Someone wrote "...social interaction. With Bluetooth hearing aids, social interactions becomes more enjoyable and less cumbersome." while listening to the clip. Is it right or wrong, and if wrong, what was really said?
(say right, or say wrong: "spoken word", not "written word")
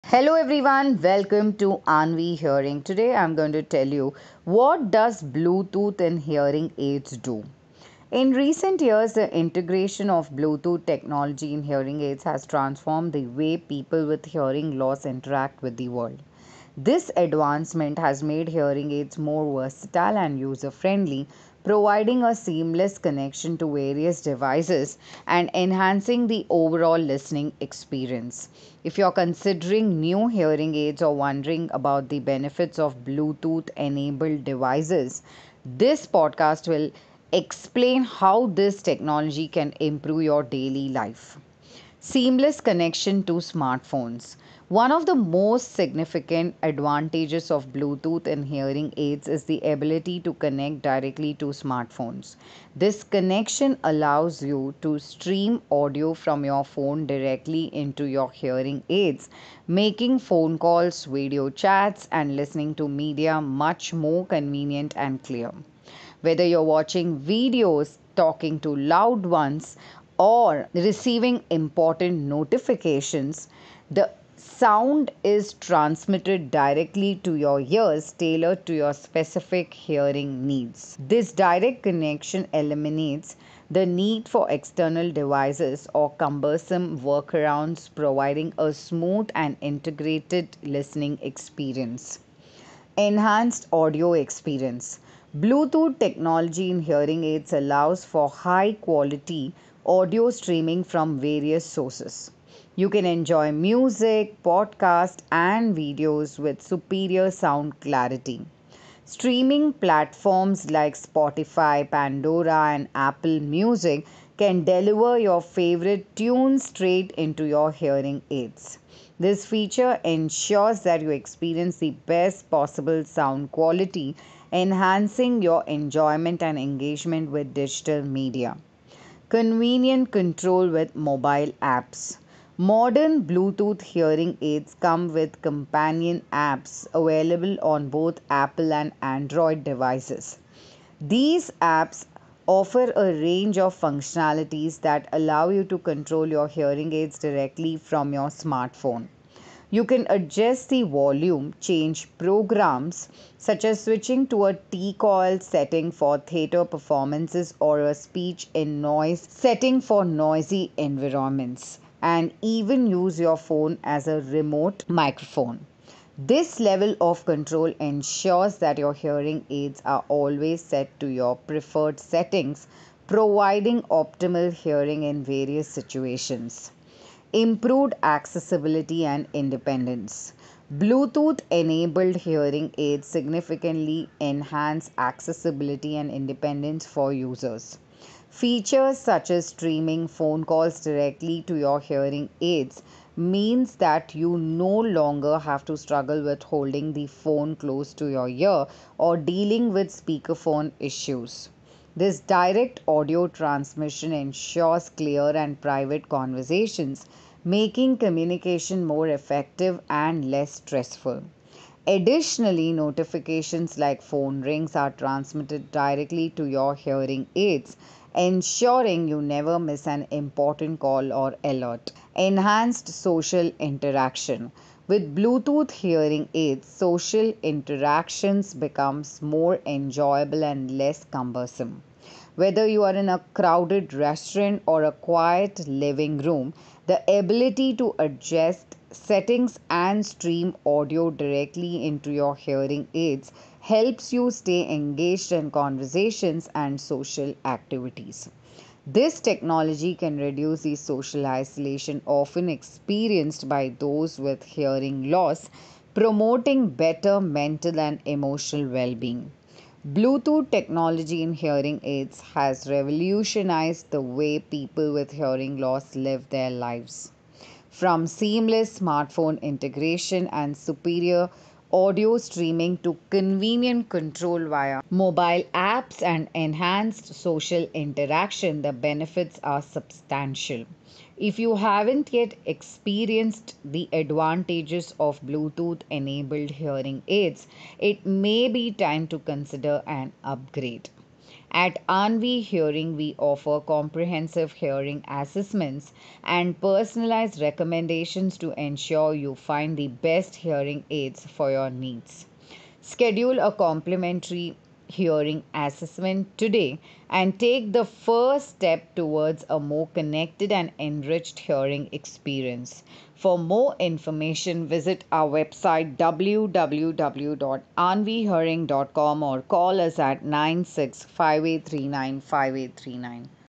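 right.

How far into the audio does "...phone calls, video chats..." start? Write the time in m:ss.
1:00.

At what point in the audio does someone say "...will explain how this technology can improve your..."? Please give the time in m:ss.
0:36.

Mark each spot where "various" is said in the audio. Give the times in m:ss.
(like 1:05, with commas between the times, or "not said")
0:23, 1:41, 2:55.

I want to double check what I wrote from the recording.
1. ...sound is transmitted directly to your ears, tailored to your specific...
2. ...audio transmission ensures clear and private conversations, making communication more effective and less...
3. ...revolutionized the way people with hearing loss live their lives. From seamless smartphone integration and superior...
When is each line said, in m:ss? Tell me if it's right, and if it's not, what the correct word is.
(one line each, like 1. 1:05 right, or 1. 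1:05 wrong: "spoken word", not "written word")
1. 1:14 right
2. 3:22 right
3. 4:22 right.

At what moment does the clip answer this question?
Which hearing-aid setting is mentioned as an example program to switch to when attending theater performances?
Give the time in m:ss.
2:34.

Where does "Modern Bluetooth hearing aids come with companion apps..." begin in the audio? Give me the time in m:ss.
2:12.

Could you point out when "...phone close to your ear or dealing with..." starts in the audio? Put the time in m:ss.
3:17.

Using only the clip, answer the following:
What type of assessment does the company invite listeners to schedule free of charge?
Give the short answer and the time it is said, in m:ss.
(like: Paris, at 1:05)
Complimentary hearing assessment, at 5:03.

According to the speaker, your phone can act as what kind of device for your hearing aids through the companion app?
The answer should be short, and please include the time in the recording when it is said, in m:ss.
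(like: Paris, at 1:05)
Remote microphone, at 2:44.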